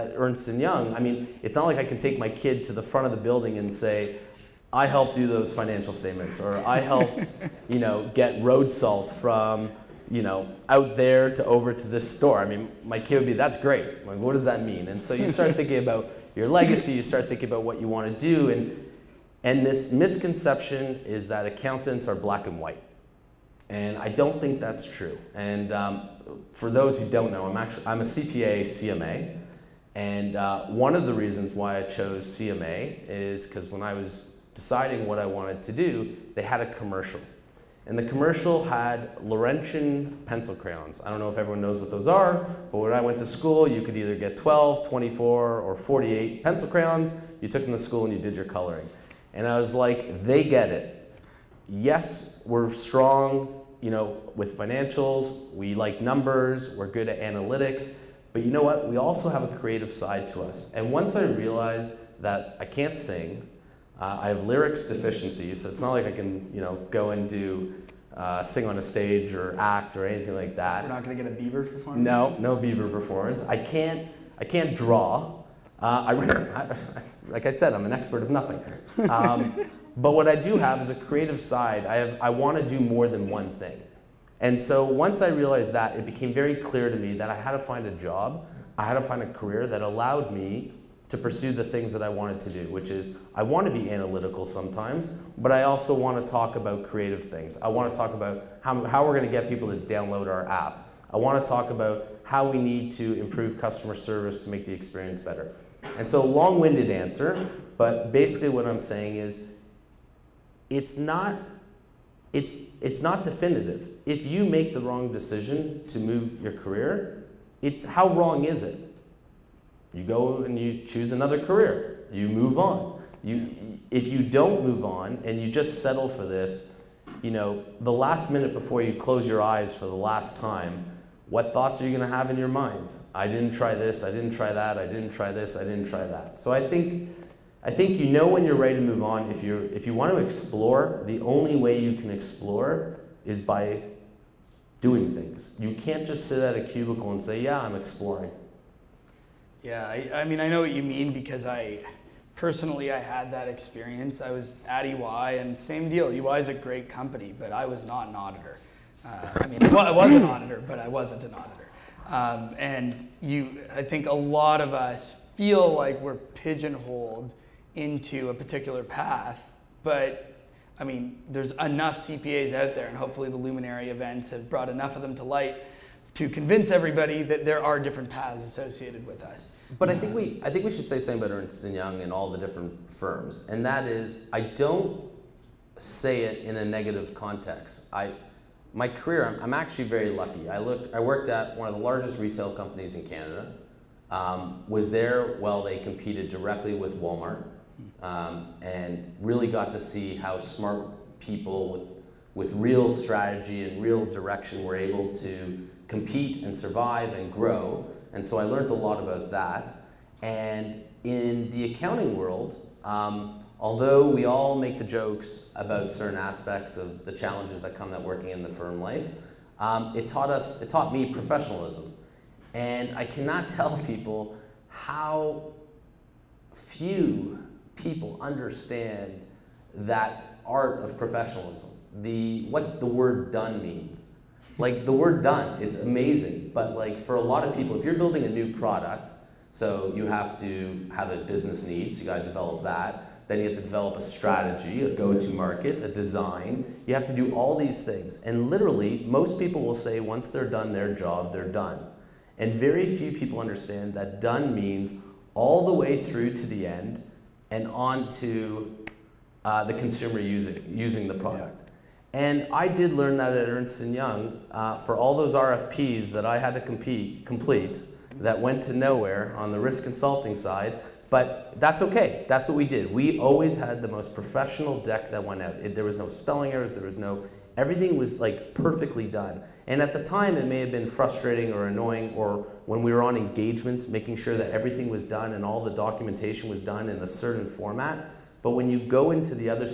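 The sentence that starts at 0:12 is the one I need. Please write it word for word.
I mean, my kid would be, that's great.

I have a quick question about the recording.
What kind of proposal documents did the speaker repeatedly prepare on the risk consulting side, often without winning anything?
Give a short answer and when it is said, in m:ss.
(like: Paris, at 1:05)
RFPs, at 4:25.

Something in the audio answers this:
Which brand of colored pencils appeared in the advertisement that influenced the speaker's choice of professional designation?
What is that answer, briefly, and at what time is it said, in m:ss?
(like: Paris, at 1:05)
Laurentien, at 0:39.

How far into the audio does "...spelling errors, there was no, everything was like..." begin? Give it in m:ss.
4:36.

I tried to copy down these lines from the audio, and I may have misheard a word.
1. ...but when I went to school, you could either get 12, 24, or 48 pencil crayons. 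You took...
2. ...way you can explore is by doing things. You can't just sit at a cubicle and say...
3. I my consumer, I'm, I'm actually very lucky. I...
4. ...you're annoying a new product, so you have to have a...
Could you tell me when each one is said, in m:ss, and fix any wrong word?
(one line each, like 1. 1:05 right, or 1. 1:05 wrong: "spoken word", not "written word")
1. 0:42 right
2. 2:21 right
3. 3:07 wrong: "career", not "consumer"
4. 3:57 wrong: "building", not "annoying".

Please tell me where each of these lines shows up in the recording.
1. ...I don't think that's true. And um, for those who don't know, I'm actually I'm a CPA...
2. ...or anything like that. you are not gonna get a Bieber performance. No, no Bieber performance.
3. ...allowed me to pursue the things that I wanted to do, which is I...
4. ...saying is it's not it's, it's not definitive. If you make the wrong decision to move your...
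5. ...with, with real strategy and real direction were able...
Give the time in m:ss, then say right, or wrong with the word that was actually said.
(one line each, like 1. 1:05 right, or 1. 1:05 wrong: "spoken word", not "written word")
1. 0:23 right
2. 1:09 right
3. 1:29 right
4. 1:48 right
5. 3:21 right.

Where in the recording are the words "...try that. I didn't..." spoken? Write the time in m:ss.
2:14.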